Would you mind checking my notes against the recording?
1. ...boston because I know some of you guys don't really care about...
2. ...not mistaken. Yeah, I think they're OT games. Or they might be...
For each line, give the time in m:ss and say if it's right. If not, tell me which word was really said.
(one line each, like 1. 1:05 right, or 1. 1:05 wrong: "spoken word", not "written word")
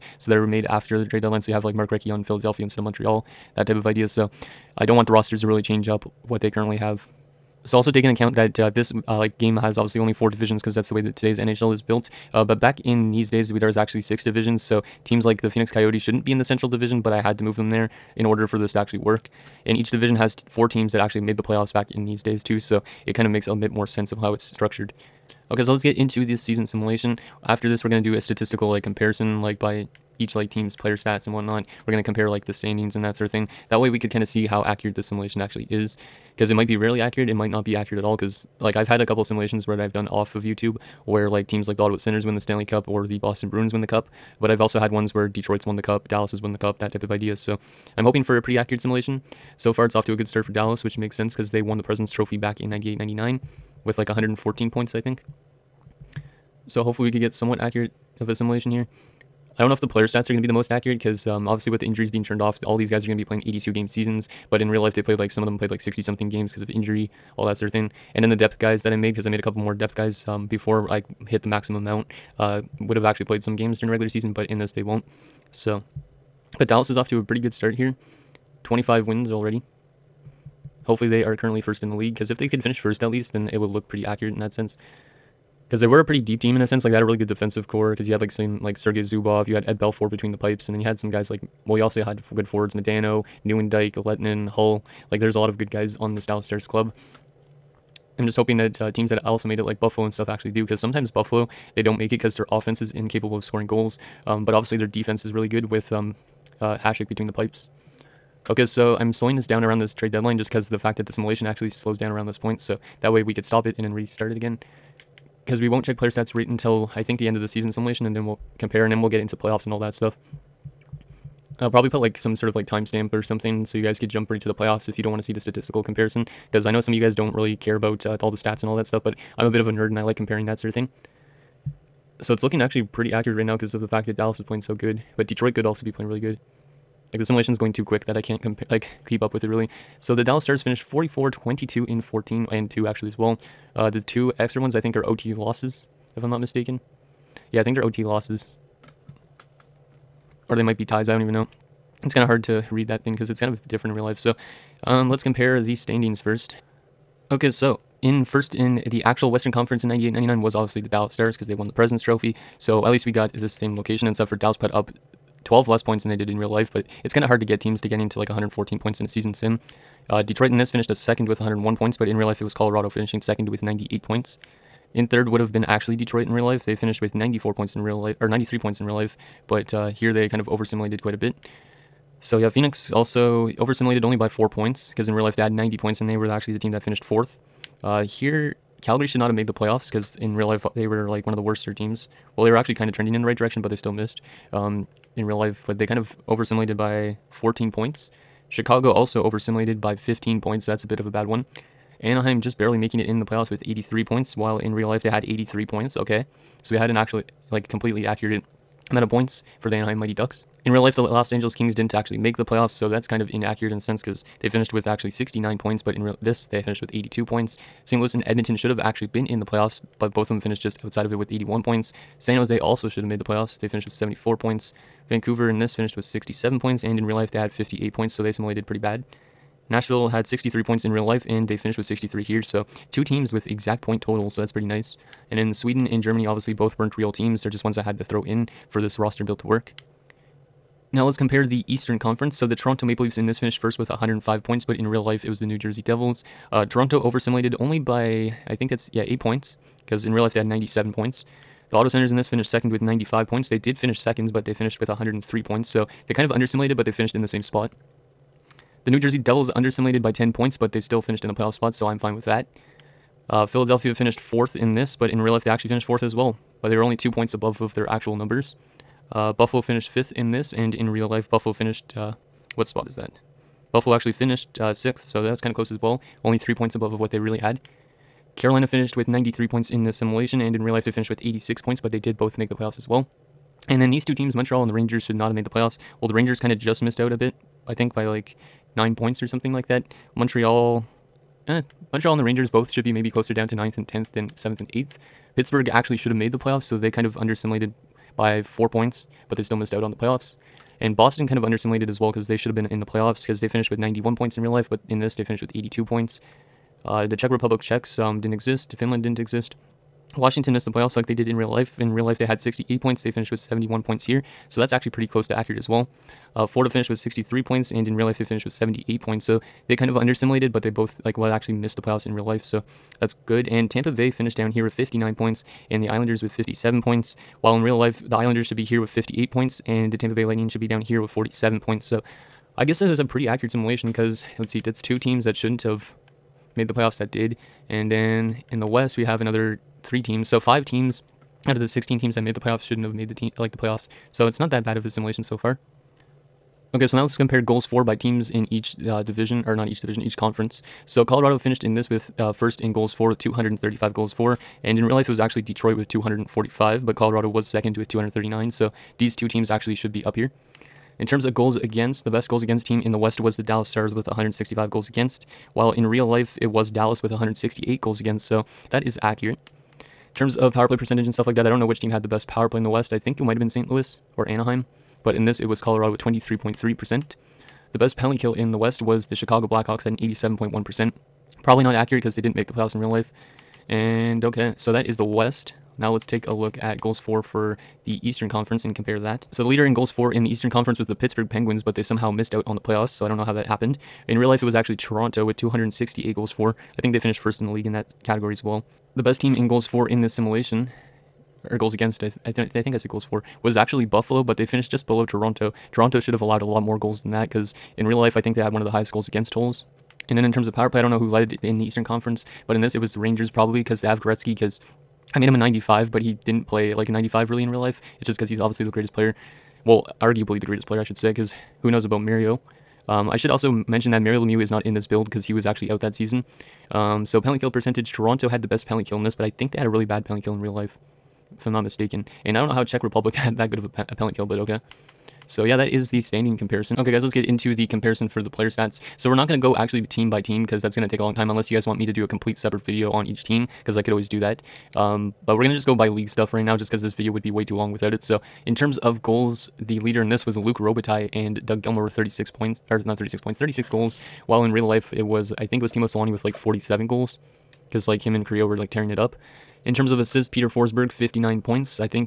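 1. 2:05 wrong: "comparison", not "boston"
2. 2:26 wrong: "losses", not "games".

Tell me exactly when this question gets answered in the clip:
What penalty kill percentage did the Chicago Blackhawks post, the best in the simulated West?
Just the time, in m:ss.
6:19.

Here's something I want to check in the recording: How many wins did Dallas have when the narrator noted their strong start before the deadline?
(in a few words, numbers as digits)
25.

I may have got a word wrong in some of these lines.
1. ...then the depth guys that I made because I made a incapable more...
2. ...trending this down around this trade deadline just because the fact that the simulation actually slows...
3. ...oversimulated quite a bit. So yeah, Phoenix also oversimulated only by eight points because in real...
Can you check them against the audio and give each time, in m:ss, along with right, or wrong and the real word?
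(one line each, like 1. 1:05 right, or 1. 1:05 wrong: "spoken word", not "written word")
1. 1:08 wrong: "couple", not "incapable"
2. 1:49 wrong: "slowing", not "trending"
3. 3:00 wrong: "four", not "eight".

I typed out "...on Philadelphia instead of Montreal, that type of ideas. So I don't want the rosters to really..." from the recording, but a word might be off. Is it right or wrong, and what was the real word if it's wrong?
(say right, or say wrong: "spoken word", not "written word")
right.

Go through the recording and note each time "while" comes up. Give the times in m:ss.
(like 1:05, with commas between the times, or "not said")
3:24, 5:27, 6:05, 7:34.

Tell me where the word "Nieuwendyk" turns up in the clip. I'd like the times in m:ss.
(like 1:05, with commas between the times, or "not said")
1:33.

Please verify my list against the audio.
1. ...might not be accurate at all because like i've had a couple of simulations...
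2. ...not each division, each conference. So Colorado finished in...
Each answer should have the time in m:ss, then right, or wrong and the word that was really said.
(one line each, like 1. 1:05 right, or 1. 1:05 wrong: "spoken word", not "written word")
1. 0:37 right
2. 5:49 right.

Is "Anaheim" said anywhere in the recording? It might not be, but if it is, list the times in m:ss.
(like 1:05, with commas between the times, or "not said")
3:22, 3:29, 6:14.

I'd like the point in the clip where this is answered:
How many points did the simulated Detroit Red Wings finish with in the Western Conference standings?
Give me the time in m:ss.
2:51.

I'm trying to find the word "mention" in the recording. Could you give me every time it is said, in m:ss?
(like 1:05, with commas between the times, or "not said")
7:03.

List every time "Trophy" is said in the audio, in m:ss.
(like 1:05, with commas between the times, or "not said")
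0:52, 2:42.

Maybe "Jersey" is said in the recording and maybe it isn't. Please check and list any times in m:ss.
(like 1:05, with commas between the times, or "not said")
4:05, 4:18.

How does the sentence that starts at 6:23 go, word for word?
And okay, so that is the West.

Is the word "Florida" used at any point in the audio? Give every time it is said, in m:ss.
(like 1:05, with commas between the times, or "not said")
5:16.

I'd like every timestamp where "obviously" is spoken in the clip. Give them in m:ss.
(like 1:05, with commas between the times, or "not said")
0:09, 1:01, 1:44, 2:40, 3:56, 6:58.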